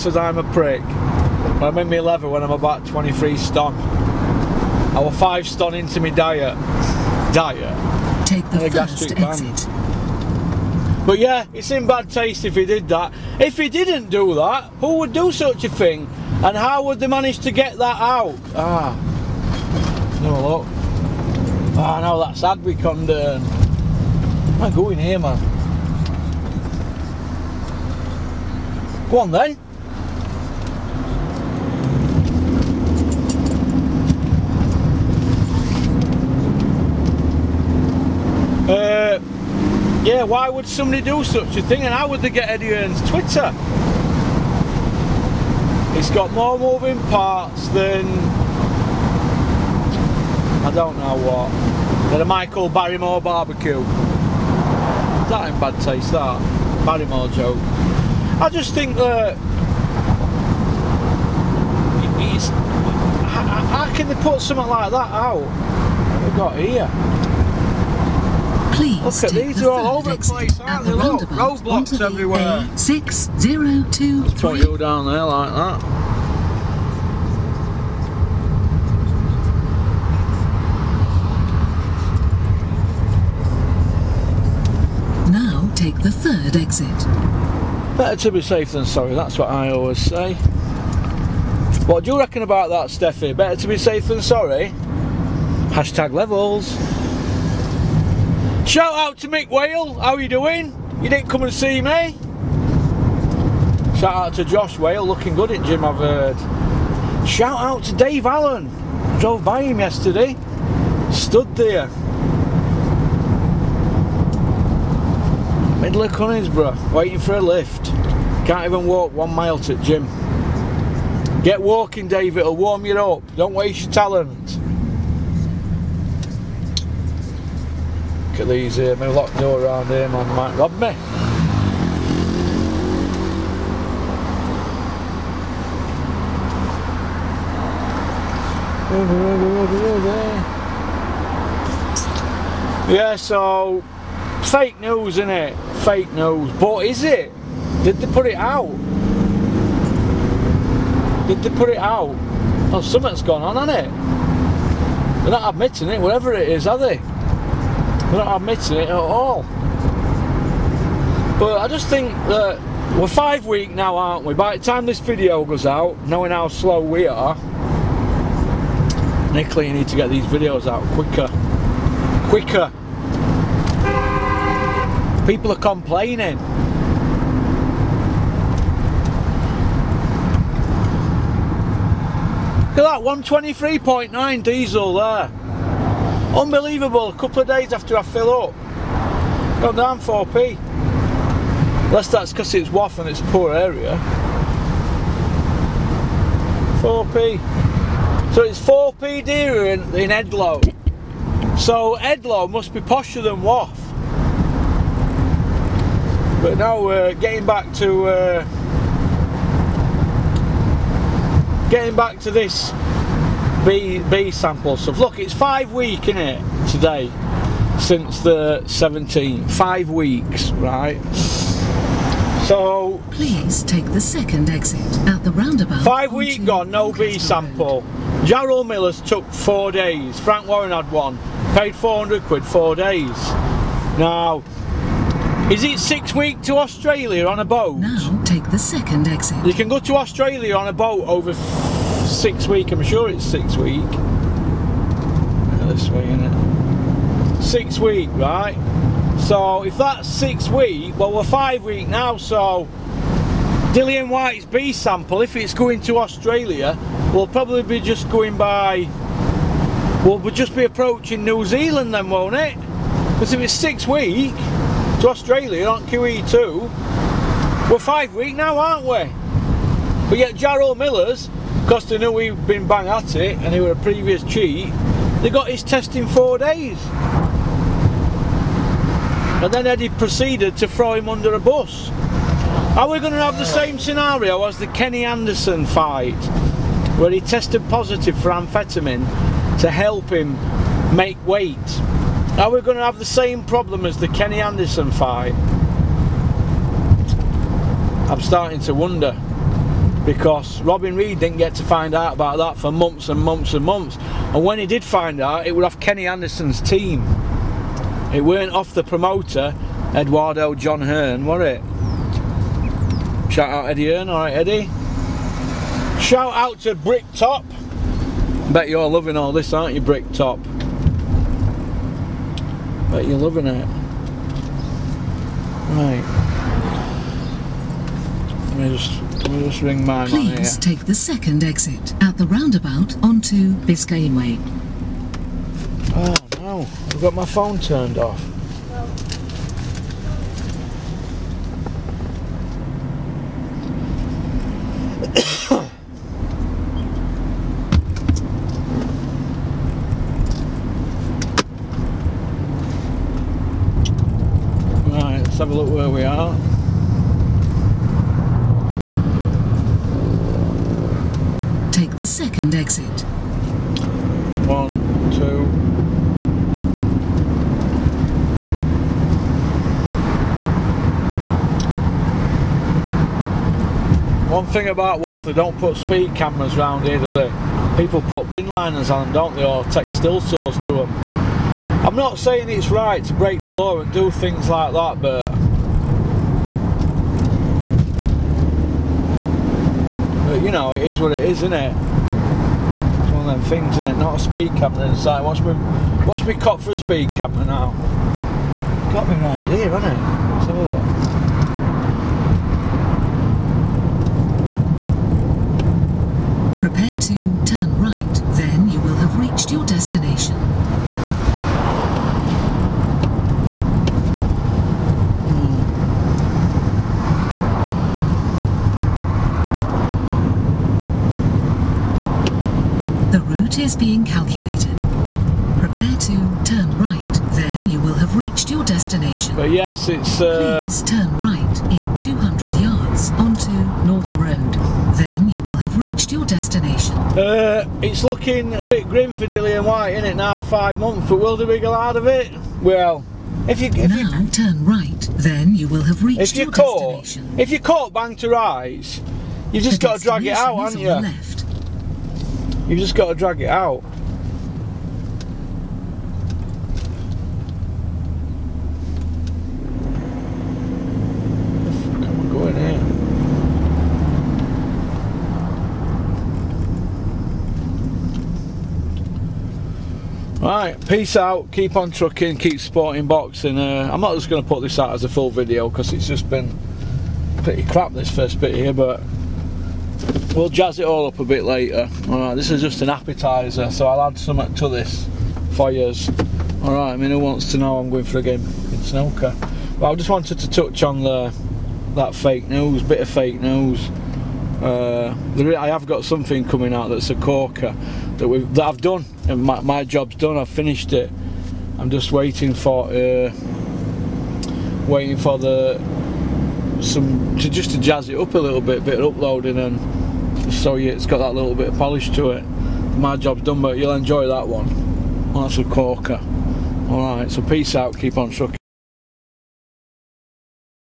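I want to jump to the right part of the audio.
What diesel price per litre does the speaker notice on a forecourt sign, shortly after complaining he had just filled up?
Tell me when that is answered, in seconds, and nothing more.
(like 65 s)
183 s.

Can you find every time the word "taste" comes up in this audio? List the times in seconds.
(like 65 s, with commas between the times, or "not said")
12 s, 55 s.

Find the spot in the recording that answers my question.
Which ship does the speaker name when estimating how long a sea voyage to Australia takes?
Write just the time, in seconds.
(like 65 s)
265 s.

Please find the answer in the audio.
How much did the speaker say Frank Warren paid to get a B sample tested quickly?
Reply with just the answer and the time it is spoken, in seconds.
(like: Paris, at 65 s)
400 quid, at 231 s.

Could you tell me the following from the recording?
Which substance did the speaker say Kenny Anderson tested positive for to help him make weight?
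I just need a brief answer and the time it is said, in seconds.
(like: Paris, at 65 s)
amphetamine, at 288 s.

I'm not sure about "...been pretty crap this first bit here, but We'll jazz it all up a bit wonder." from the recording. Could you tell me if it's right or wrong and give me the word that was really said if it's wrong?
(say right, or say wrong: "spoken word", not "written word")
wrong: "later", not "wonder".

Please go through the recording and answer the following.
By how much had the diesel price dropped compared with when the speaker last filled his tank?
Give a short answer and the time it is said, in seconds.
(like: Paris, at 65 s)
4p, at 189 s.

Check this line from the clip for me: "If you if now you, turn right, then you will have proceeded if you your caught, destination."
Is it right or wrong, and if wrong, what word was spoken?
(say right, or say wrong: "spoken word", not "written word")
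wrong: "reached", not "proceeded".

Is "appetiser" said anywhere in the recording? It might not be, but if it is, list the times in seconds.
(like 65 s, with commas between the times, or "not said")
482 s.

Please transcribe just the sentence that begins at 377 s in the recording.
People put bin liners on them, don't they, or take still source to them.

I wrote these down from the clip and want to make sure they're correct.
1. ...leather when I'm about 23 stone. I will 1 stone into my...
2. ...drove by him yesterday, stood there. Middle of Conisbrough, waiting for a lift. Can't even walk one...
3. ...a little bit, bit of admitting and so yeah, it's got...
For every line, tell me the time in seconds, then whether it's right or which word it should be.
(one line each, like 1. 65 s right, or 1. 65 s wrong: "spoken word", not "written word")
1. 1 s wrong: "5", not "1"
2. 109 s right
3. 508 s wrong: "uploading", not "admitting".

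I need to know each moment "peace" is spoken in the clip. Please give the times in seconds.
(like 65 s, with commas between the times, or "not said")
470 s, 517 s.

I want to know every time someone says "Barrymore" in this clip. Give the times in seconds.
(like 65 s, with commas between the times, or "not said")
52 s, 56 s.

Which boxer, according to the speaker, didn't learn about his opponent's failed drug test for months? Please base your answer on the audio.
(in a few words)
Robin Reid.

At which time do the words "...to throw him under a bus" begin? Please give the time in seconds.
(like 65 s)
280 s.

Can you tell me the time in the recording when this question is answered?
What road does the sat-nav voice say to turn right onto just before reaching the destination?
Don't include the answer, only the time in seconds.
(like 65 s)
433 s.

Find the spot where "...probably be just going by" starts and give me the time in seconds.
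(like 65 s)
257 s.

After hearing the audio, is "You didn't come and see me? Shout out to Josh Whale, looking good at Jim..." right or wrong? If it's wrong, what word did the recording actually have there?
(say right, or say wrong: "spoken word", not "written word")
right.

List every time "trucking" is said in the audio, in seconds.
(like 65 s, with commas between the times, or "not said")
471 s, 518 s.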